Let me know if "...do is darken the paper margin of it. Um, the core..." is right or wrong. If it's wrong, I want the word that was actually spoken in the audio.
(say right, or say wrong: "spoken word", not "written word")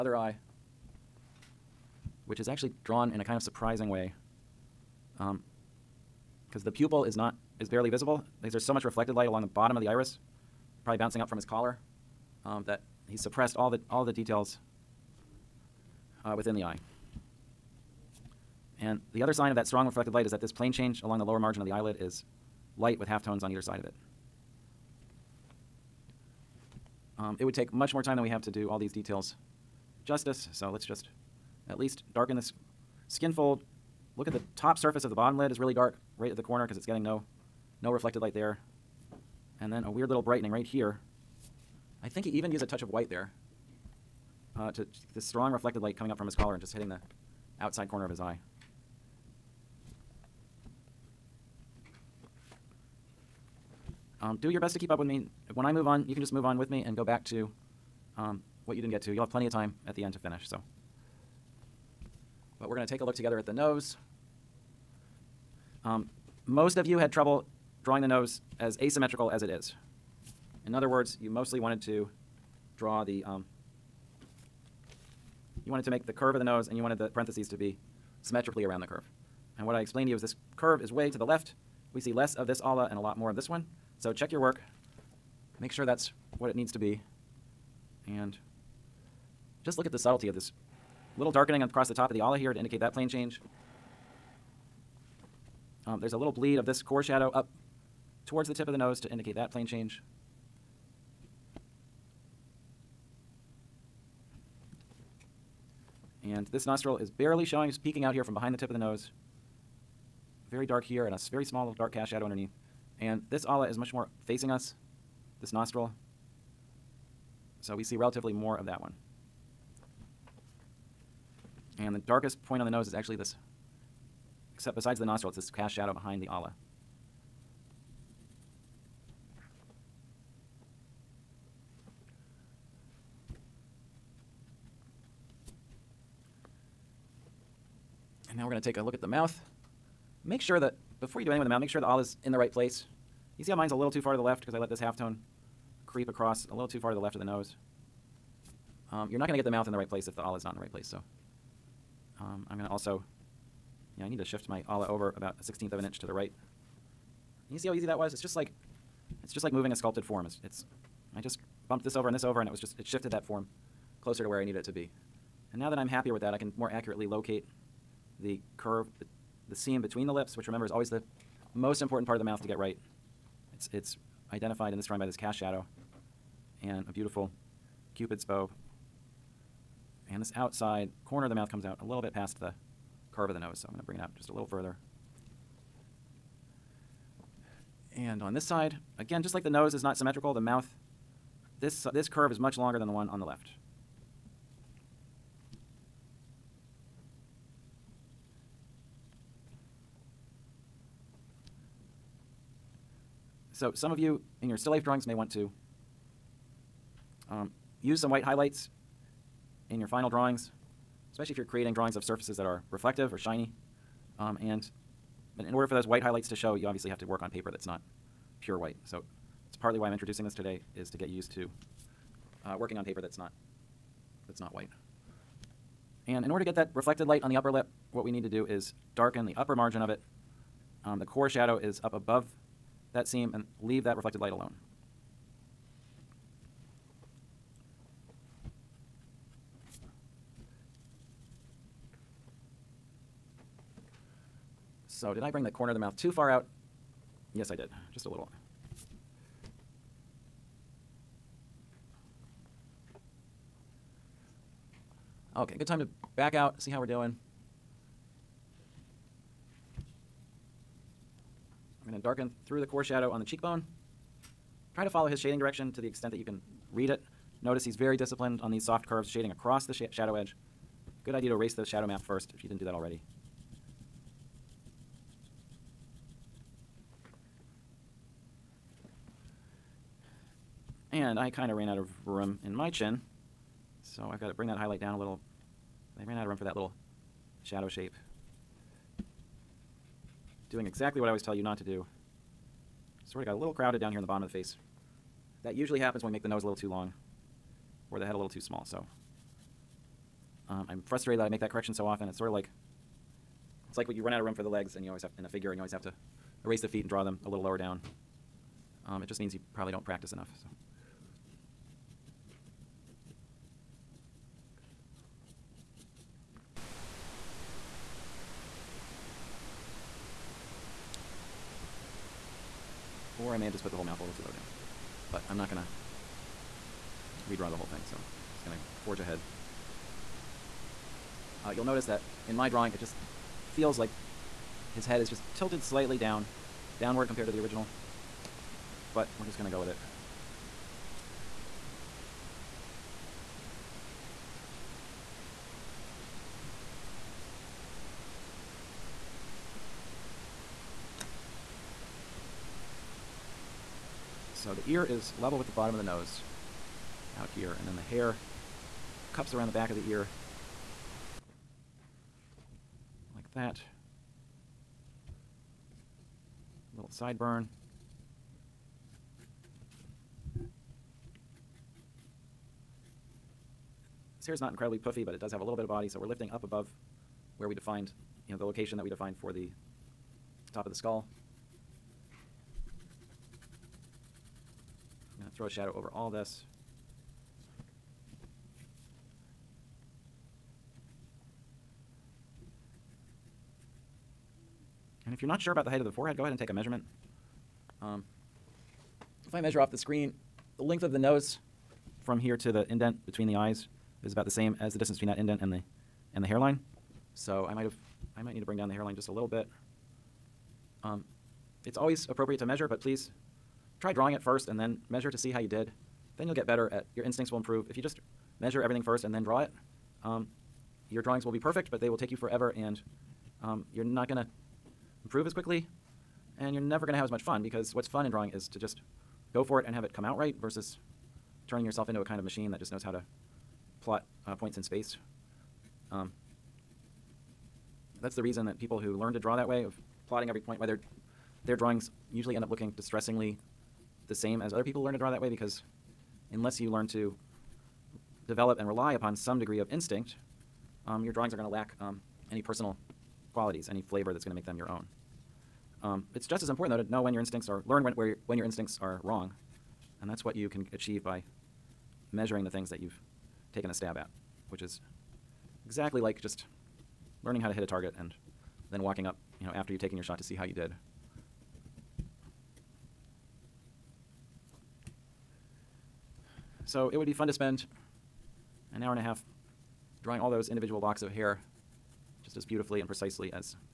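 wrong: "upper", not "paper".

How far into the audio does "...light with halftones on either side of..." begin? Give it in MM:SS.
00:22.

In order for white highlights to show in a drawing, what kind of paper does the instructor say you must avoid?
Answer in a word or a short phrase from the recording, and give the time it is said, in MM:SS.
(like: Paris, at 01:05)
pure white, at 03:38.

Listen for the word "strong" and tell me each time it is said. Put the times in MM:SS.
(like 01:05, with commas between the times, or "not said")
00:19, 00:45.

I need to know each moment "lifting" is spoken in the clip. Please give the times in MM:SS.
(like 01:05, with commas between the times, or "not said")
06:16.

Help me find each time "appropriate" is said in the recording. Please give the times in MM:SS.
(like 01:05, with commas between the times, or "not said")
06:52.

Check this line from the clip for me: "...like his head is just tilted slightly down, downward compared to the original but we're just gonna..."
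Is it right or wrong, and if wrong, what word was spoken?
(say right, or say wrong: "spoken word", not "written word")
right.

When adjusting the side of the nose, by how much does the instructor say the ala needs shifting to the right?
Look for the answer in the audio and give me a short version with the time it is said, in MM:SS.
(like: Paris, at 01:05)
a sixteenth of an inch, at 02:35.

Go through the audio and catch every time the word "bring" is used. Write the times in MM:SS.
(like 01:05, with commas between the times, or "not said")
03:03, 04:05, 04:44, 06:48.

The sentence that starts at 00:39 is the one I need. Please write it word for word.
And then a weird little brightening right here.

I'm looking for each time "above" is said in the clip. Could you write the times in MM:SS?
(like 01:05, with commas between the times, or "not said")
03:51, 06:16.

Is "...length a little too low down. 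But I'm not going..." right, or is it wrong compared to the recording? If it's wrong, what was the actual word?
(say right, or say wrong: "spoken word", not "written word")
wrong: "mouth", not "length".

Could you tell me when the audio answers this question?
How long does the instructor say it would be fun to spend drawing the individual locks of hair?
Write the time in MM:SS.
07:58.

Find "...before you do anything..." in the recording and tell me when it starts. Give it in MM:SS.
02:21.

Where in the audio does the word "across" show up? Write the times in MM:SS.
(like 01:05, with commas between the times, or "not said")
01:31, 02:26, 04:29.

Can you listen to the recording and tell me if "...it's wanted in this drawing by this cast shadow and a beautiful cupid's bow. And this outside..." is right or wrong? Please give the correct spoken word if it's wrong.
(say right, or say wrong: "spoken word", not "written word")
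wrong: "identified", not "wanted".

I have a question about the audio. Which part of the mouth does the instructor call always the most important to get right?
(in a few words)
the seam between the lips.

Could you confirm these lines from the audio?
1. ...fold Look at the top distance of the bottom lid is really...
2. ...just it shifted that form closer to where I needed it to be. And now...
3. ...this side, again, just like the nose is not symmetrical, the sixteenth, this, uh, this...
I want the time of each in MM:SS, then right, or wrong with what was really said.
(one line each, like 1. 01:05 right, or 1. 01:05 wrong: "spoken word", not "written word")
1. 00:33 wrong: "surface", not "distance"
2. 02:42 right
3. 03:08 wrong: "mouth", not "sixteenth".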